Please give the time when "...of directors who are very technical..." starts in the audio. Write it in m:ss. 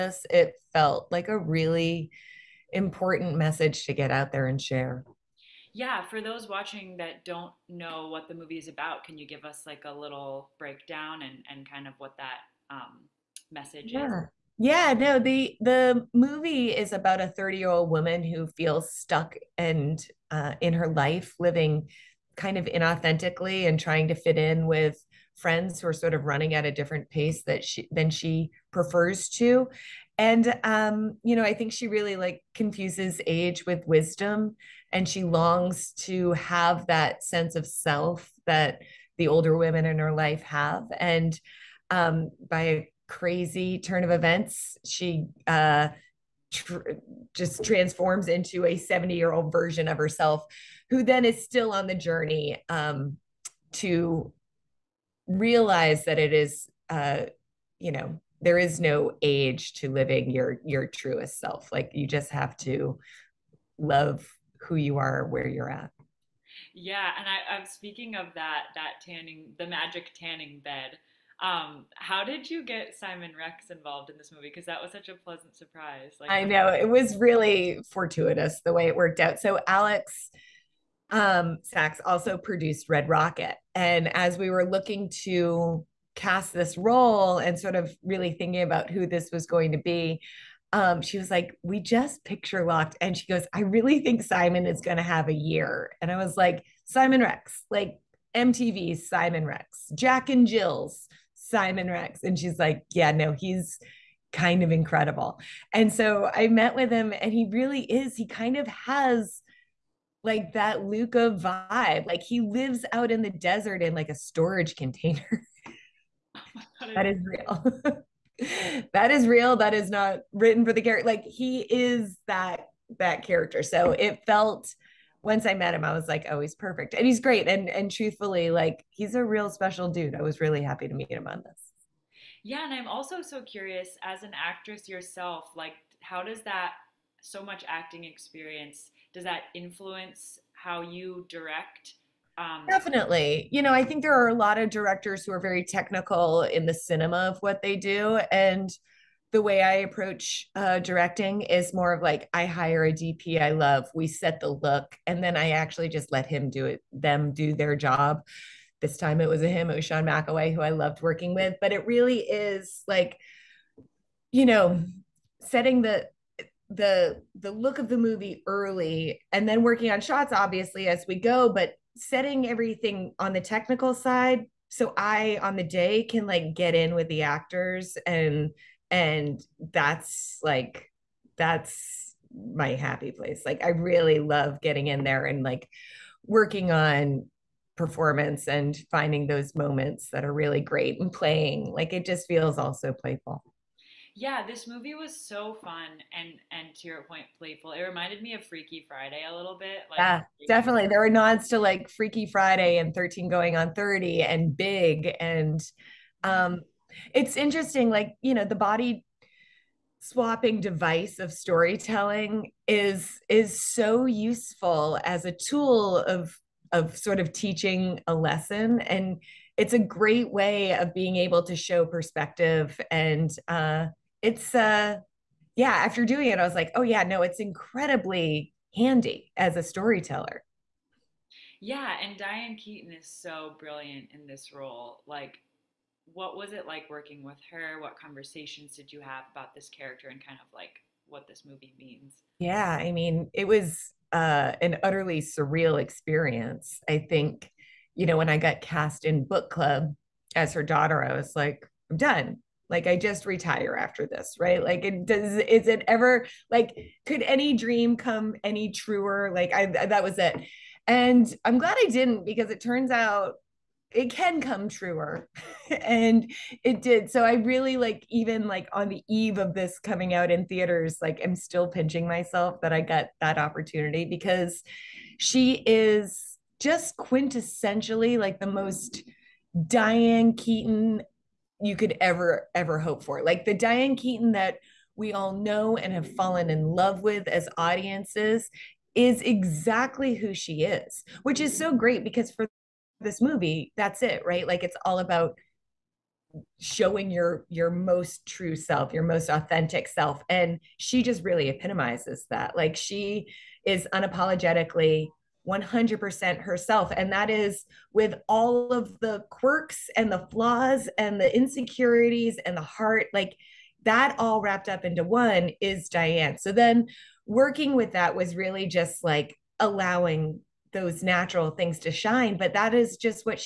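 2:24.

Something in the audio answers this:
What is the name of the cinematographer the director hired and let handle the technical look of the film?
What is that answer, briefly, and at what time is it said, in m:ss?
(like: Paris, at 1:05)
Sean McAway, at 2:39.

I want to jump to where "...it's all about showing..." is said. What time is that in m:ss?
4:54.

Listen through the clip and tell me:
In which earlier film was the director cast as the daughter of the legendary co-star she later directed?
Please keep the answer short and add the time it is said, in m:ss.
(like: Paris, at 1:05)
Book Club, at 4:09.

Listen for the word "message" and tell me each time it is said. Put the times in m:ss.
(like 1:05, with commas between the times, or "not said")
0:03, 0:13.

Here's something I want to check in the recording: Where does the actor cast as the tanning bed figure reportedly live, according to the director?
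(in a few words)
a storage container.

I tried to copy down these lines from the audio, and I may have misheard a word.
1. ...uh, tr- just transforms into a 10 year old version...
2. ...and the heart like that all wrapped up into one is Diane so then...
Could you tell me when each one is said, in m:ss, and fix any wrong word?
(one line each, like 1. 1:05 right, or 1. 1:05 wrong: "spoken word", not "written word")
1. 0:45 wrong: "70", not "10"
2. 5:12 right.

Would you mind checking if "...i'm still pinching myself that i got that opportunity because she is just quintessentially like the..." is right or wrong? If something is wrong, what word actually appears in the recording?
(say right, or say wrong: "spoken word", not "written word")
right.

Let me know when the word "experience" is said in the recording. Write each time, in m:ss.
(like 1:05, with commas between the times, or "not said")
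2:18, 4:05.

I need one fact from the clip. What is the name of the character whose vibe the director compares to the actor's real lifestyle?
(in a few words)
Luca.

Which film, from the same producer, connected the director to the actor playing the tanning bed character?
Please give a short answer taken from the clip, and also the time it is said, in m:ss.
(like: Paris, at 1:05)
Red Rocket, at 1:22.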